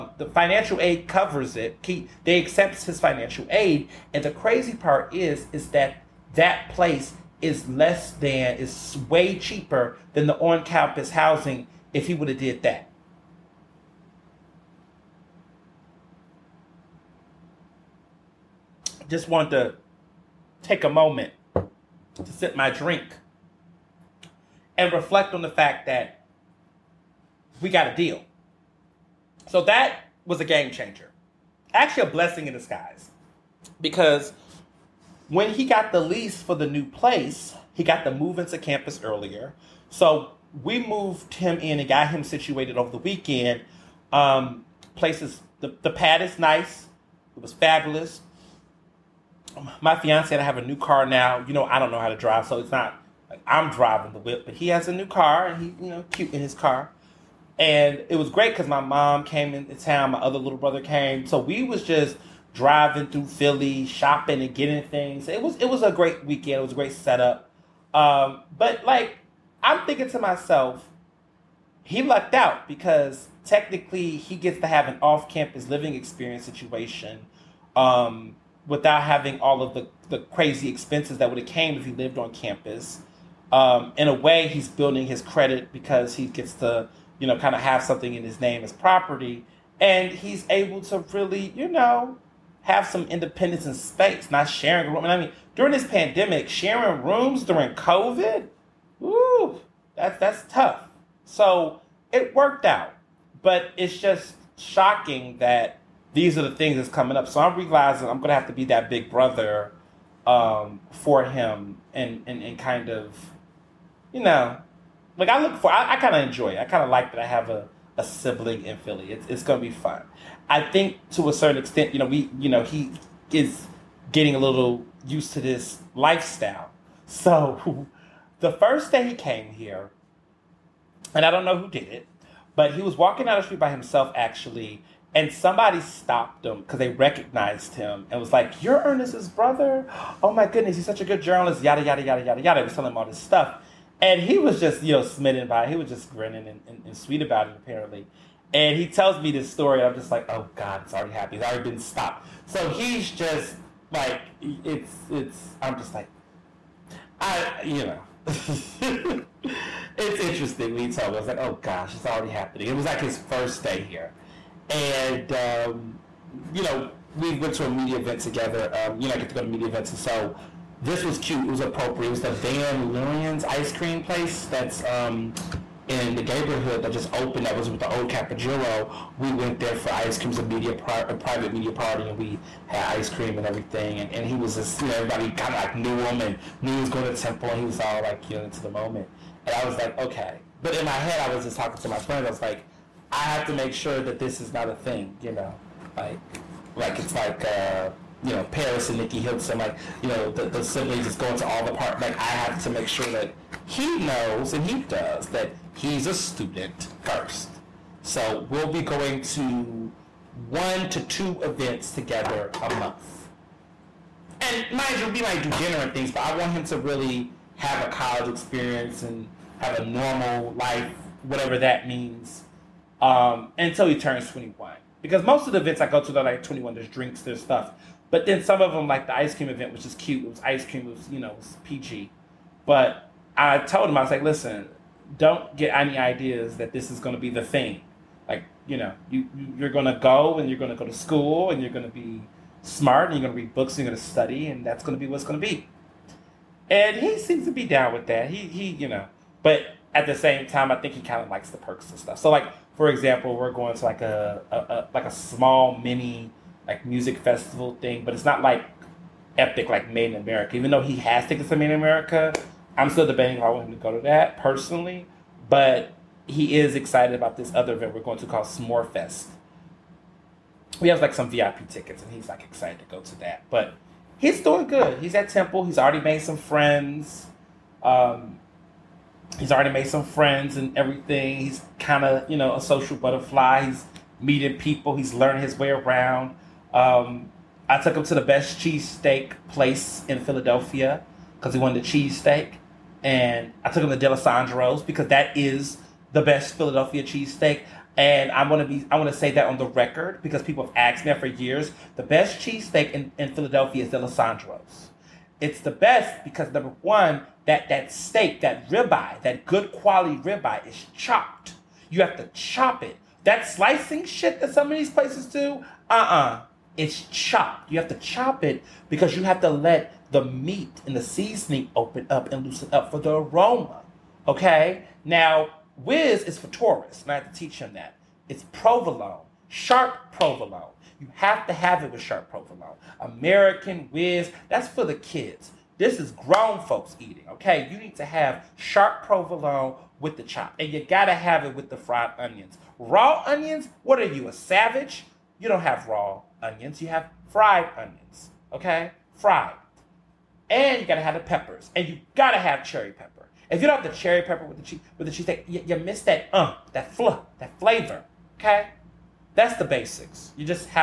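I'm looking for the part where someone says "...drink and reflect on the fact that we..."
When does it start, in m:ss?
0:22.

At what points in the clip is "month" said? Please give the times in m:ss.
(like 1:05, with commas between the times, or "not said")
3:32.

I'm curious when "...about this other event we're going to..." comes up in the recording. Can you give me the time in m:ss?
4:27.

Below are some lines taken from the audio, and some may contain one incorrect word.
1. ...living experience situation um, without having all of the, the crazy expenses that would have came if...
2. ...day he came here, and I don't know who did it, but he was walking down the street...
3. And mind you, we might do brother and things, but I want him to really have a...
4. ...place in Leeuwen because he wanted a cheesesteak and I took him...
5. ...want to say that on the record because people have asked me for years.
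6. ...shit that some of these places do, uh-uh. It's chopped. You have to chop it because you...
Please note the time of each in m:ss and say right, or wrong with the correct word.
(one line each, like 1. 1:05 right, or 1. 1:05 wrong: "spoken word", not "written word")
1. 1:15 right
2. 2:08 right
3. 3:34 wrong: "dinner", not "brother"
4. 4:49 wrong: "Philadelphia", not "Leeuwen"
5. 4:58 right
6. 5:14 right.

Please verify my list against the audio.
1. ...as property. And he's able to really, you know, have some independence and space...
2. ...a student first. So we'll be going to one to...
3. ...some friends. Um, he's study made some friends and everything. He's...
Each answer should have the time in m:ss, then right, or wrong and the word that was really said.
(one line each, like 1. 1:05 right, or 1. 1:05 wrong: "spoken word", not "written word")
1. 1:28 right
2. 3:26 right
3. 4:36 wrong: "already", not "study".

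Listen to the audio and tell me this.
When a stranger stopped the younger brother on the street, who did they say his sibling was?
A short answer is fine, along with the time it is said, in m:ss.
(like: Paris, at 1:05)
Ernest, at 2:18.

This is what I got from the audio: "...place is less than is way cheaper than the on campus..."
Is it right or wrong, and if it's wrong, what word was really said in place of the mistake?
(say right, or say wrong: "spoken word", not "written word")
right.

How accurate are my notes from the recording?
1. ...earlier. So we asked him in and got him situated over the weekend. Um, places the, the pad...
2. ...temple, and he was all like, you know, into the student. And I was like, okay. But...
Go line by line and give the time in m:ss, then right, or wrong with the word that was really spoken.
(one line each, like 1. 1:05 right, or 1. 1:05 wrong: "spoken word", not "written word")
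1. 0:39 wrong: "moved", not "asked"
2. 3:07 wrong: "moment", not "student".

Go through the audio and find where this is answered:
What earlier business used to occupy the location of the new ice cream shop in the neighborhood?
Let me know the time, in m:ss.
2:58.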